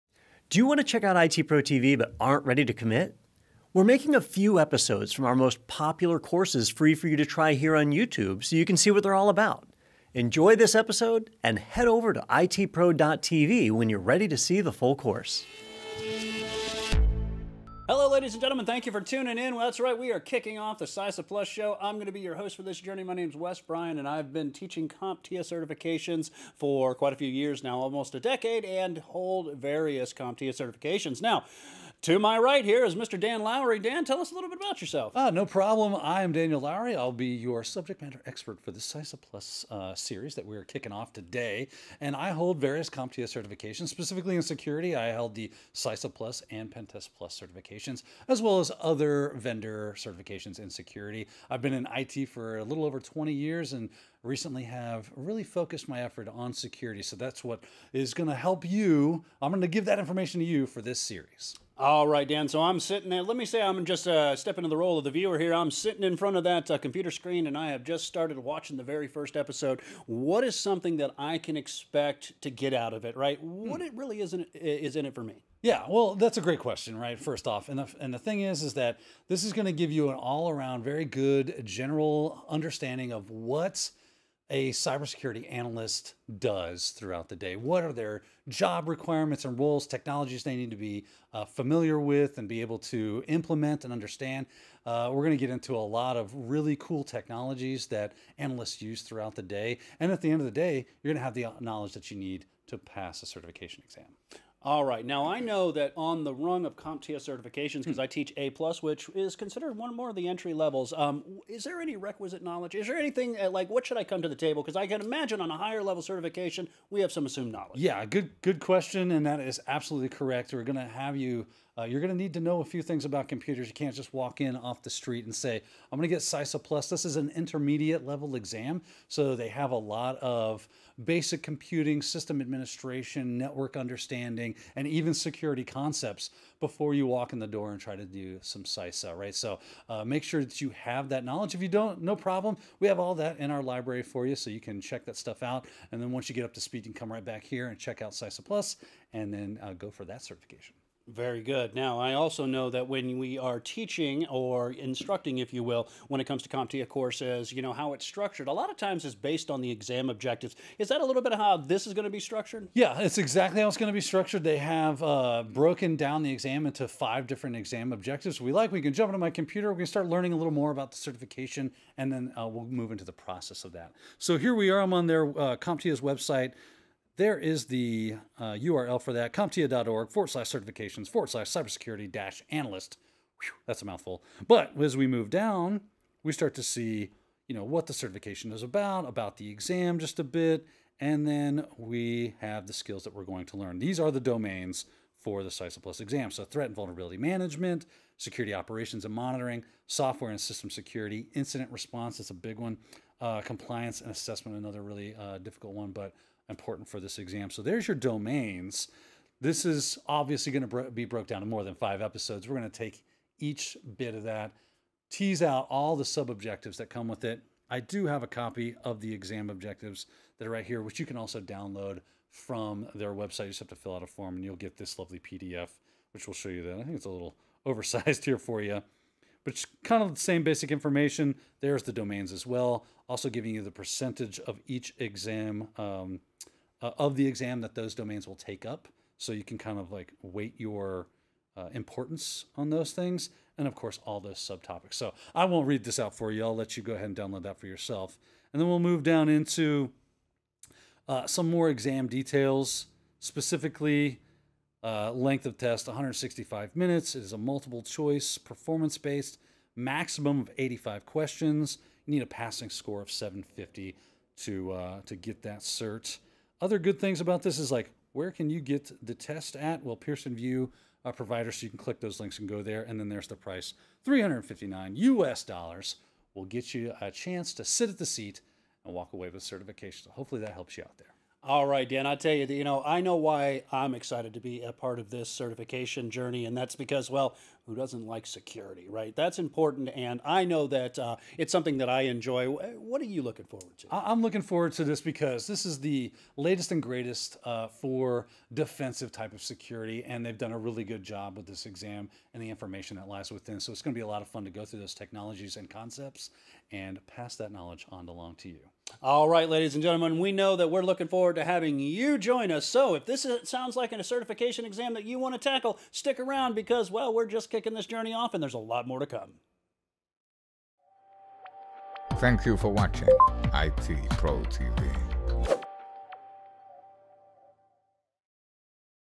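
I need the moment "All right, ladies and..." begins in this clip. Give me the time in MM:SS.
05:09.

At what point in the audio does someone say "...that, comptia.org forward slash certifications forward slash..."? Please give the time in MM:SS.
02:59.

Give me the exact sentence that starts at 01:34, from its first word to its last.
Uh, we're going to get into a lot of really cool technologies that analysts use throughout the day.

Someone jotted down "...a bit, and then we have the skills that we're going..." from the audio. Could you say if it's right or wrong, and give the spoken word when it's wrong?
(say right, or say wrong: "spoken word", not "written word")
right.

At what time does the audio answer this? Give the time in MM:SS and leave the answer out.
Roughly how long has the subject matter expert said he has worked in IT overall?
00:52.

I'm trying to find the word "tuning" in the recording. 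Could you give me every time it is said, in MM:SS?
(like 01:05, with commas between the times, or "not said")
00:19.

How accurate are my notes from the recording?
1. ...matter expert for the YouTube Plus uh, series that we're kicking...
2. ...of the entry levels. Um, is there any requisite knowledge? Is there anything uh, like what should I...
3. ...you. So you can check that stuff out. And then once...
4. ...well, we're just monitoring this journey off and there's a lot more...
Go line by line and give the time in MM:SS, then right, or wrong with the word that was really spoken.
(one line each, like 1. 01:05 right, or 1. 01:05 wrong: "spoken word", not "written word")
1. 00:38 wrong: "CySA", not "YouTube"
2. 01:50 right
3. 02:24 right
4. 05:16 wrong: "kicking", not "monitoring".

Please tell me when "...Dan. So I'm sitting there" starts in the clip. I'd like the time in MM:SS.
01:02.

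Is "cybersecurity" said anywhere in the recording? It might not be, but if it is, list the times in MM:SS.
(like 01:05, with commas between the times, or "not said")
01:24, 03:01.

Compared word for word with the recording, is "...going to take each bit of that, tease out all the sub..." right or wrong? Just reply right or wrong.
right.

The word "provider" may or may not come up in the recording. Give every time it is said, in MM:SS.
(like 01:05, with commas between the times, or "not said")
04:31.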